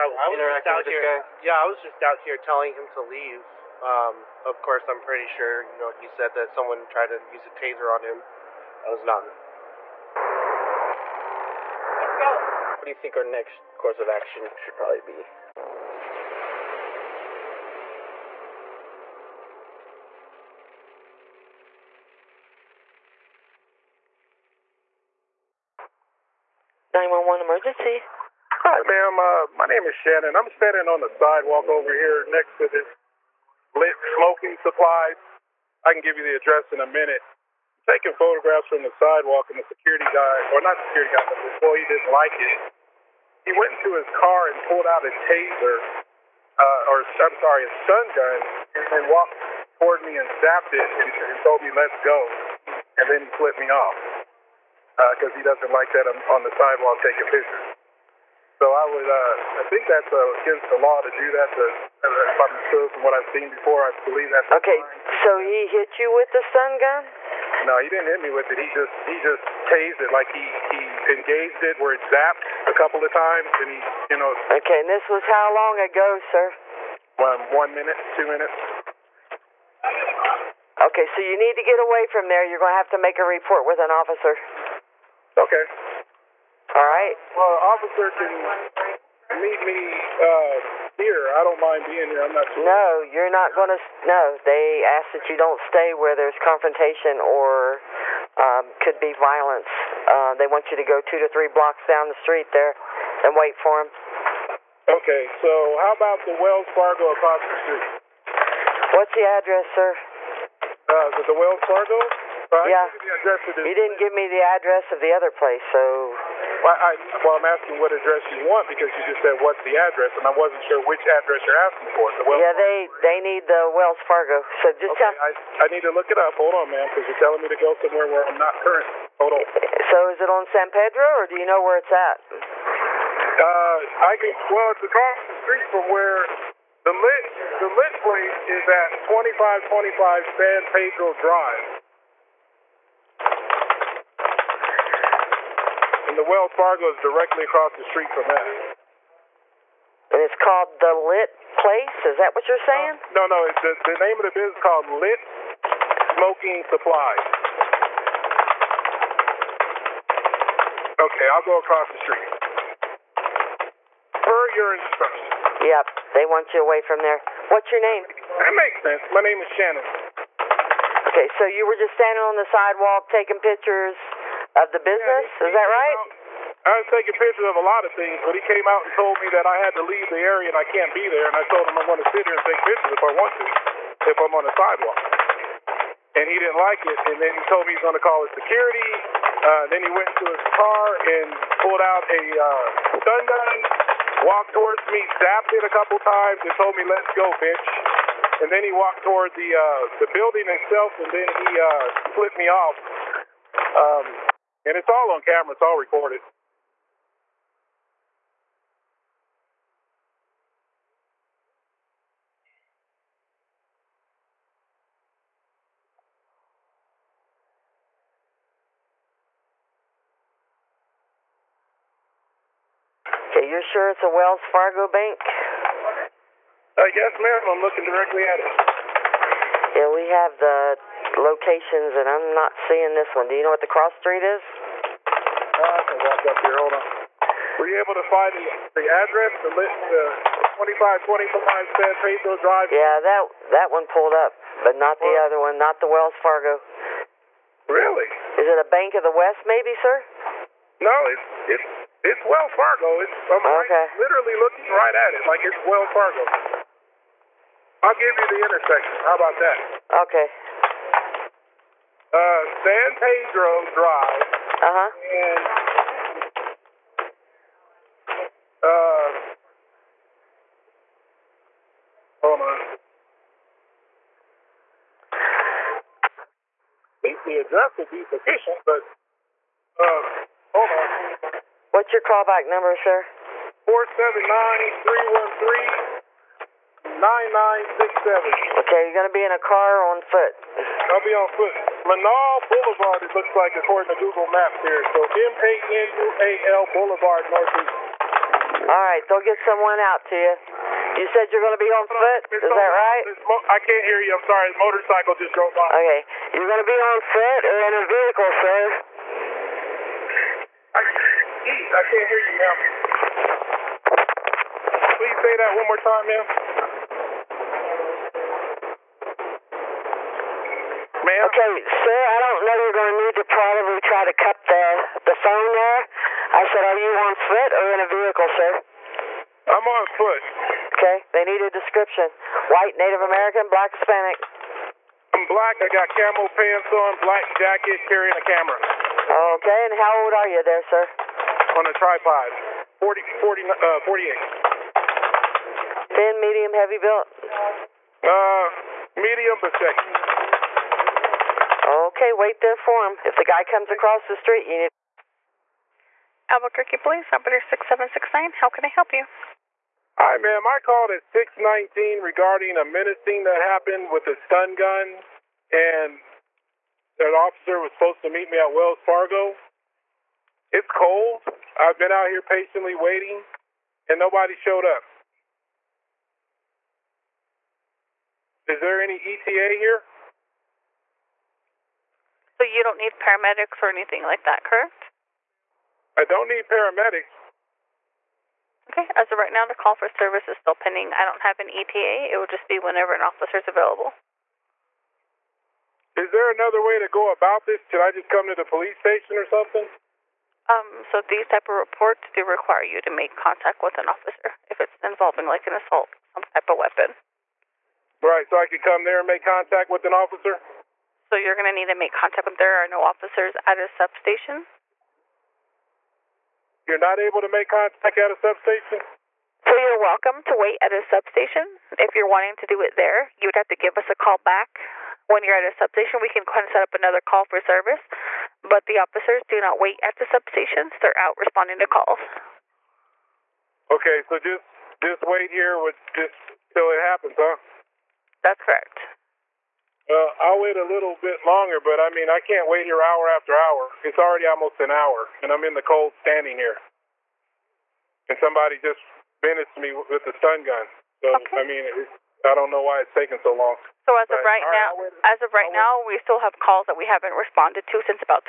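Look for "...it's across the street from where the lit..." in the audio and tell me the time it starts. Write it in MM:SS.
02:14.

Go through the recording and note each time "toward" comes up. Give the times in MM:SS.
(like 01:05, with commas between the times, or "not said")
00:49, 03:14, 03:19.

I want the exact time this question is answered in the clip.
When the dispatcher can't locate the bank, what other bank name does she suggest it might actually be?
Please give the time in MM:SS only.
04:08.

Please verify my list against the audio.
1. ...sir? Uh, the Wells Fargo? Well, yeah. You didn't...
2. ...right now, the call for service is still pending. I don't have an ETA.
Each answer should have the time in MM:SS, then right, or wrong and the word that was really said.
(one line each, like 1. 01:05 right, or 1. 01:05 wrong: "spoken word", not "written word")
1. 01:49 right
2. 06:29 right.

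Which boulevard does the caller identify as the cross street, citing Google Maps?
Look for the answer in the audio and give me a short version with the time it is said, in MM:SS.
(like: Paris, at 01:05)
Menaul Boulevard, at 04:51.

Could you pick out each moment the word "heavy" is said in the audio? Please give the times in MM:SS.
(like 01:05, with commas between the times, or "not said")
05:46.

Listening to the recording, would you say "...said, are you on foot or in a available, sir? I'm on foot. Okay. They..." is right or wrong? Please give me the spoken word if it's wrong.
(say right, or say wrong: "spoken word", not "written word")
wrong: "vehicle", not "available".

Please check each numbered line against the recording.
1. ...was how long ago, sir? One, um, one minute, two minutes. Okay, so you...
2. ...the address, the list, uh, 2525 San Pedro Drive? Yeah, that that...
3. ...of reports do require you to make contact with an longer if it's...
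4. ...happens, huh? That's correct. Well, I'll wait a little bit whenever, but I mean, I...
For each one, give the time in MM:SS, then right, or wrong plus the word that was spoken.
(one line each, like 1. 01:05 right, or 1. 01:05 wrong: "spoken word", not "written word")
1. 01:15 right
2. 03:58 right
3. 06:41 wrong: "officer", not "longer"
4. 07:16 wrong: "longer", not "whenever".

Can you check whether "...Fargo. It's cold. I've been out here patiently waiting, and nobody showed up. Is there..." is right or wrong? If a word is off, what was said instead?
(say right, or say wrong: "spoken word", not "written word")
right.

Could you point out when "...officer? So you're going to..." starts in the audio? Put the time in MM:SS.
06:49.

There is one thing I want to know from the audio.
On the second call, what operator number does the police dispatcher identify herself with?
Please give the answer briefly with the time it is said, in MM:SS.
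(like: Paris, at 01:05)
6769, at 05:57.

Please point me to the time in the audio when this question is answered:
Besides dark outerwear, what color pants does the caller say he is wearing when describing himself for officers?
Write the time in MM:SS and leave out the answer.
05:35.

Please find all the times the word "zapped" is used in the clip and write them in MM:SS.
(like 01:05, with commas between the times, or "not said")
00:50, 01:12, 03:15.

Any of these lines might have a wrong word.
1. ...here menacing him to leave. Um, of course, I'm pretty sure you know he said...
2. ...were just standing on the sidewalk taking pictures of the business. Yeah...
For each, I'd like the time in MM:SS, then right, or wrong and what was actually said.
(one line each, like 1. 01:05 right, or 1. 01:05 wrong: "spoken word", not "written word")
1. 00:02 wrong: "telling", not "menacing"
2. 02:51 right.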